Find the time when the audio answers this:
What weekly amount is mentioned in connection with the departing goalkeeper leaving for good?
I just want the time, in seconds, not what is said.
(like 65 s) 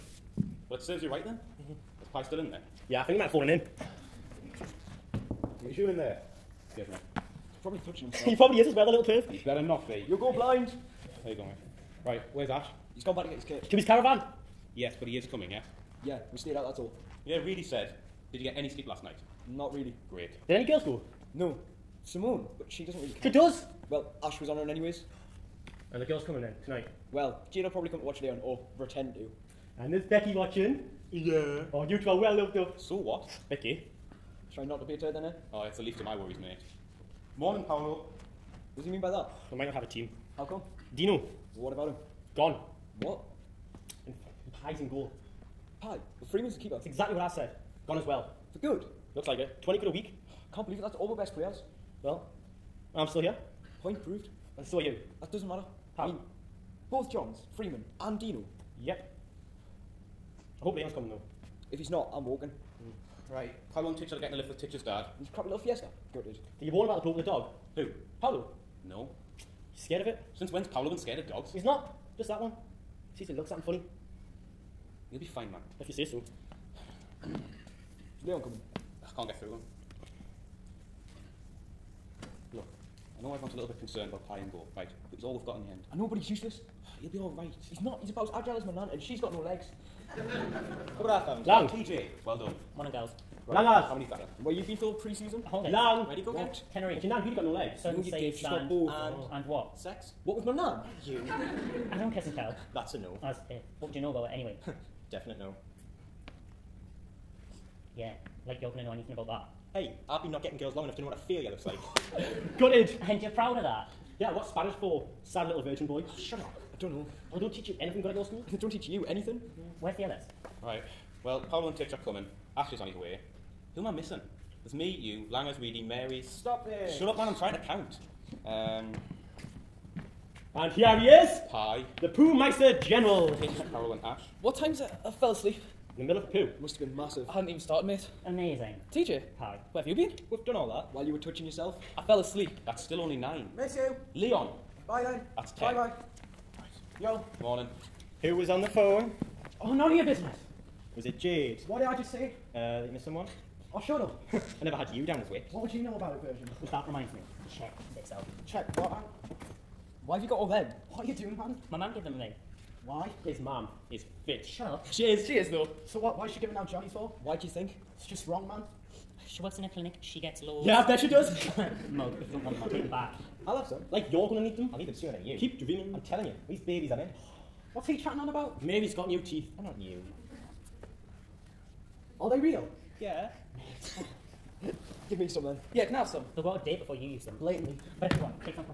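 49 s.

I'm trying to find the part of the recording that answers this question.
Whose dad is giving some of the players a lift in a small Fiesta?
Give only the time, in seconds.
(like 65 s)
64 s.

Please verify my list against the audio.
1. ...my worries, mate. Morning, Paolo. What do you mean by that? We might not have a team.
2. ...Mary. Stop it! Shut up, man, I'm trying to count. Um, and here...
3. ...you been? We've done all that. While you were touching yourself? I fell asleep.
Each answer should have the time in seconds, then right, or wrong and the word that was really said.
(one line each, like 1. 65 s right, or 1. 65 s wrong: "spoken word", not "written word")
1. 36 s right
2. 125 s right
3. 139 s right.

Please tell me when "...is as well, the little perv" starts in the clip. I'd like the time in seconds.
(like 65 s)
8 s.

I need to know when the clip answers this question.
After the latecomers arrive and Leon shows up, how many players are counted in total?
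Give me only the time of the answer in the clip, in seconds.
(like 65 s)
145 s.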